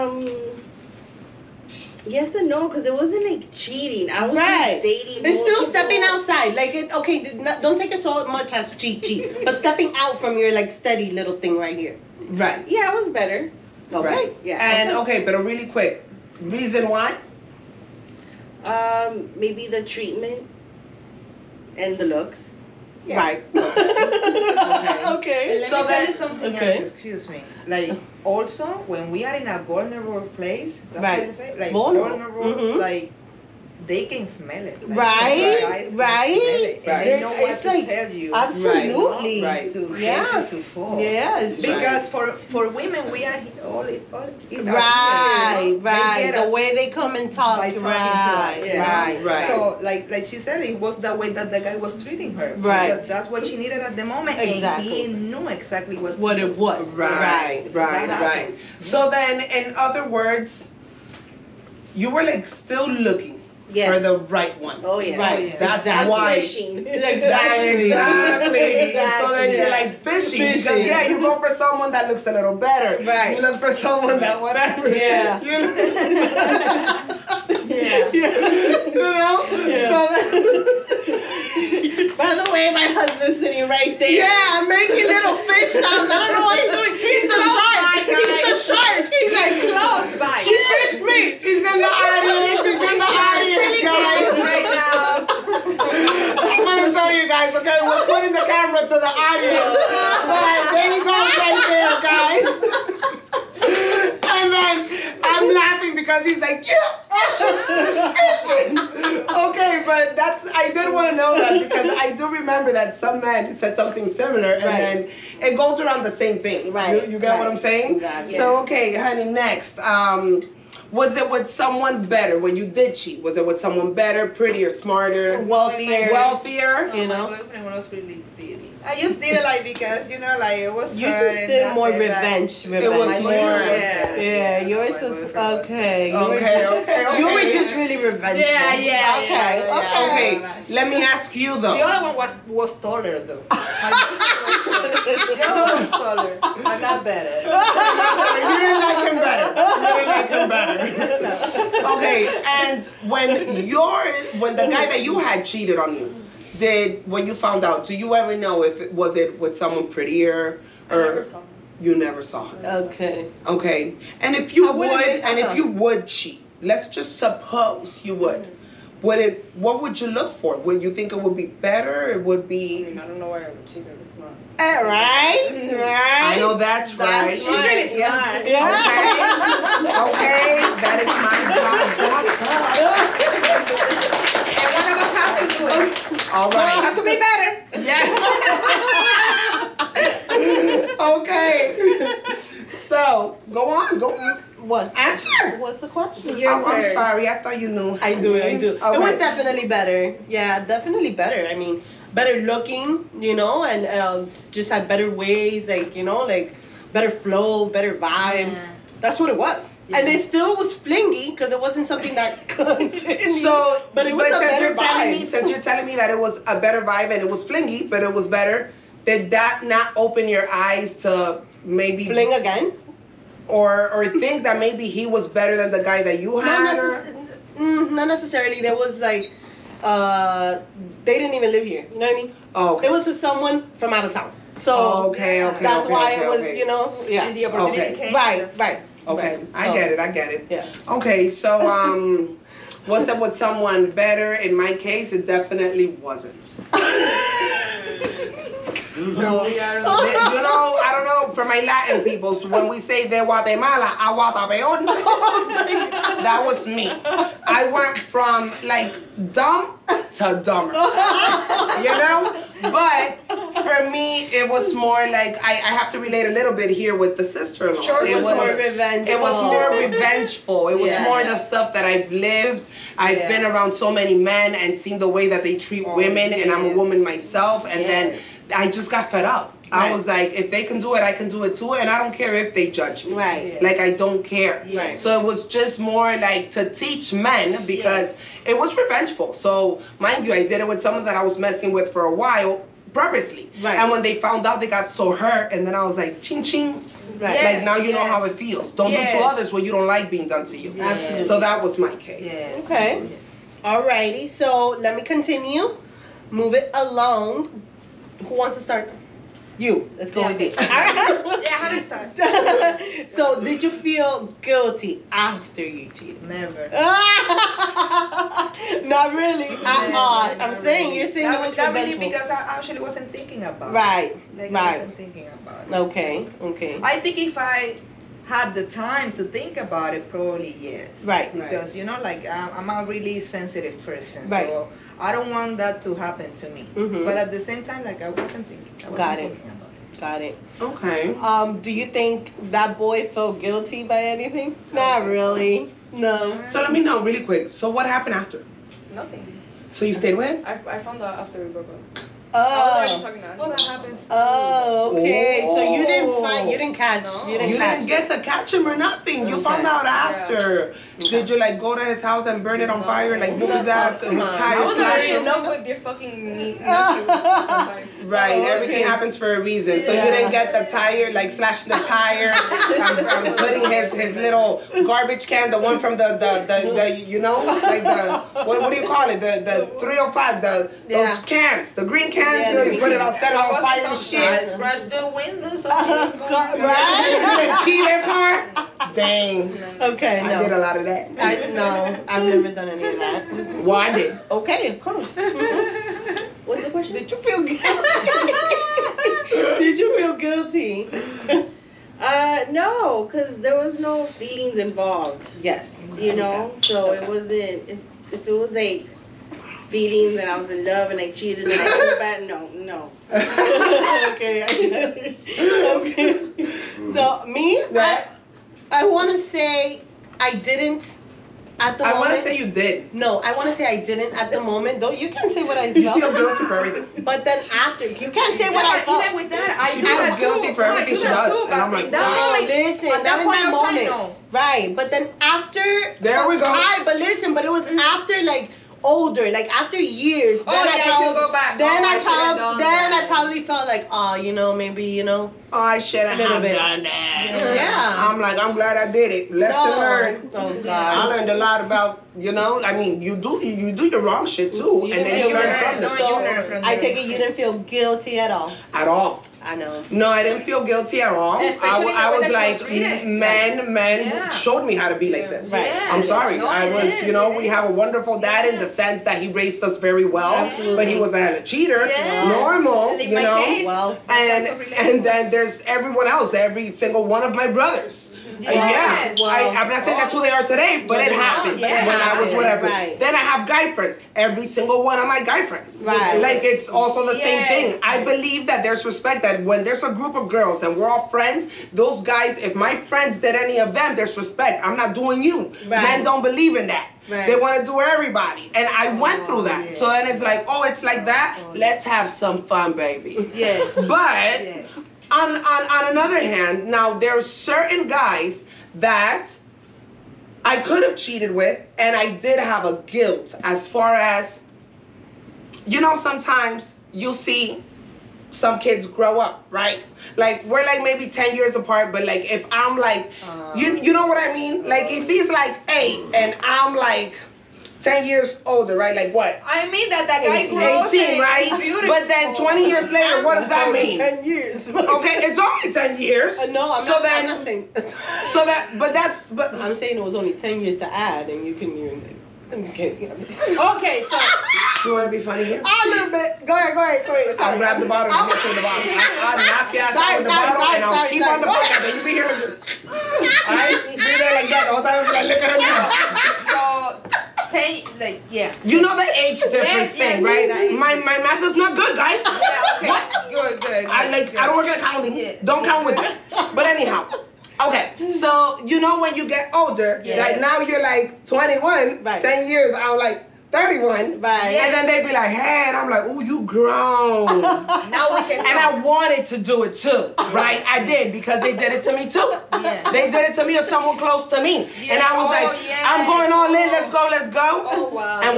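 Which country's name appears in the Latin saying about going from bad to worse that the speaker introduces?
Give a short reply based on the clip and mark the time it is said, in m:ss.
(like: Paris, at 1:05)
Guatemala, at 4:13.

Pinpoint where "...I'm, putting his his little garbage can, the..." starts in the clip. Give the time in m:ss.
6:13.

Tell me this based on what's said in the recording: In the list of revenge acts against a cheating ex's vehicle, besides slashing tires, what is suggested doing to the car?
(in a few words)
Key their car.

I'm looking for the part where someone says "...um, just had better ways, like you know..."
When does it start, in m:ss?
3:24.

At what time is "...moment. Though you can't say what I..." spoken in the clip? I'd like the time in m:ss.
7:04.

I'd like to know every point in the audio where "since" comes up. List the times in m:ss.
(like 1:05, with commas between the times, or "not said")
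3:35.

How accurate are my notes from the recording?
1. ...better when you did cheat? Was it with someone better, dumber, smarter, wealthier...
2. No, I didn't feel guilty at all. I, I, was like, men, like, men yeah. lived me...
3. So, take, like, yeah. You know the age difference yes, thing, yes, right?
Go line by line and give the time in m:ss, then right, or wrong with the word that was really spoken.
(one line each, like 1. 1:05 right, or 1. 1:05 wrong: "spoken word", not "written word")
1. 2:02 wrong: "prettier", not "dumber"
2. 7:39 wrong: "showed", not "lived"
3. 9:16 right.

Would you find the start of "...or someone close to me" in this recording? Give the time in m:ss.
9:43.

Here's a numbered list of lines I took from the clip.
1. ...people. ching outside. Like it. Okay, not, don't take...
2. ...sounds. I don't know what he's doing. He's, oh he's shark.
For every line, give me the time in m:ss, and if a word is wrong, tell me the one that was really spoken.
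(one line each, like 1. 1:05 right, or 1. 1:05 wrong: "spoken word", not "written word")
1. 0:05 wrong: "stepping", not "ching"
2. 1:25 right.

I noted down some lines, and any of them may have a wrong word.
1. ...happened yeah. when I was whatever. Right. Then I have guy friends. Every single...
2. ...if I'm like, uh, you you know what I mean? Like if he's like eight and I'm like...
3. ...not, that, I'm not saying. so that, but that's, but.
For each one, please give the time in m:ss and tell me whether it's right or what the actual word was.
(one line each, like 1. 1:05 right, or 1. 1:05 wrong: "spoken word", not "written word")
1. 8:01 right
2. 8:42 right
3. 8:56 right.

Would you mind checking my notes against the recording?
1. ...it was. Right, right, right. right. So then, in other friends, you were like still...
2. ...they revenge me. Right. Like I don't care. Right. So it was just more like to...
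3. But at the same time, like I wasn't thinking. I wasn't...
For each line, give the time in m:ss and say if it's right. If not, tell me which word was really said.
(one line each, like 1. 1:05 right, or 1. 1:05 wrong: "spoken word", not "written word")
1. 0:56 wrong: "words", not "friends"
2. 4:42 wrong: "judge", not "revenge"
3. 5:37 right.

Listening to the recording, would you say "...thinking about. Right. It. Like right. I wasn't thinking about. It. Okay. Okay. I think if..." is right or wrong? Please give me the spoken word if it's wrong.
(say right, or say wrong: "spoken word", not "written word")
right.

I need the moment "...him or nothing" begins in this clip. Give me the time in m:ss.
5:58.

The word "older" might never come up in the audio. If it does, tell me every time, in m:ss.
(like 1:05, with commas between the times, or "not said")
7:18, 8:48, 9:29.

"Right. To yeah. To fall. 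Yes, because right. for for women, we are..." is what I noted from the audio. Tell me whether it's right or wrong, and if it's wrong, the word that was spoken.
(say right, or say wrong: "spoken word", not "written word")
right.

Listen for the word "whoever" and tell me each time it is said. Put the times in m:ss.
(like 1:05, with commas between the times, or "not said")
not said.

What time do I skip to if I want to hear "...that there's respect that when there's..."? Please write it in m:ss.
8:08.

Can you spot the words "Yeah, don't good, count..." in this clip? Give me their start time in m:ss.
9:25.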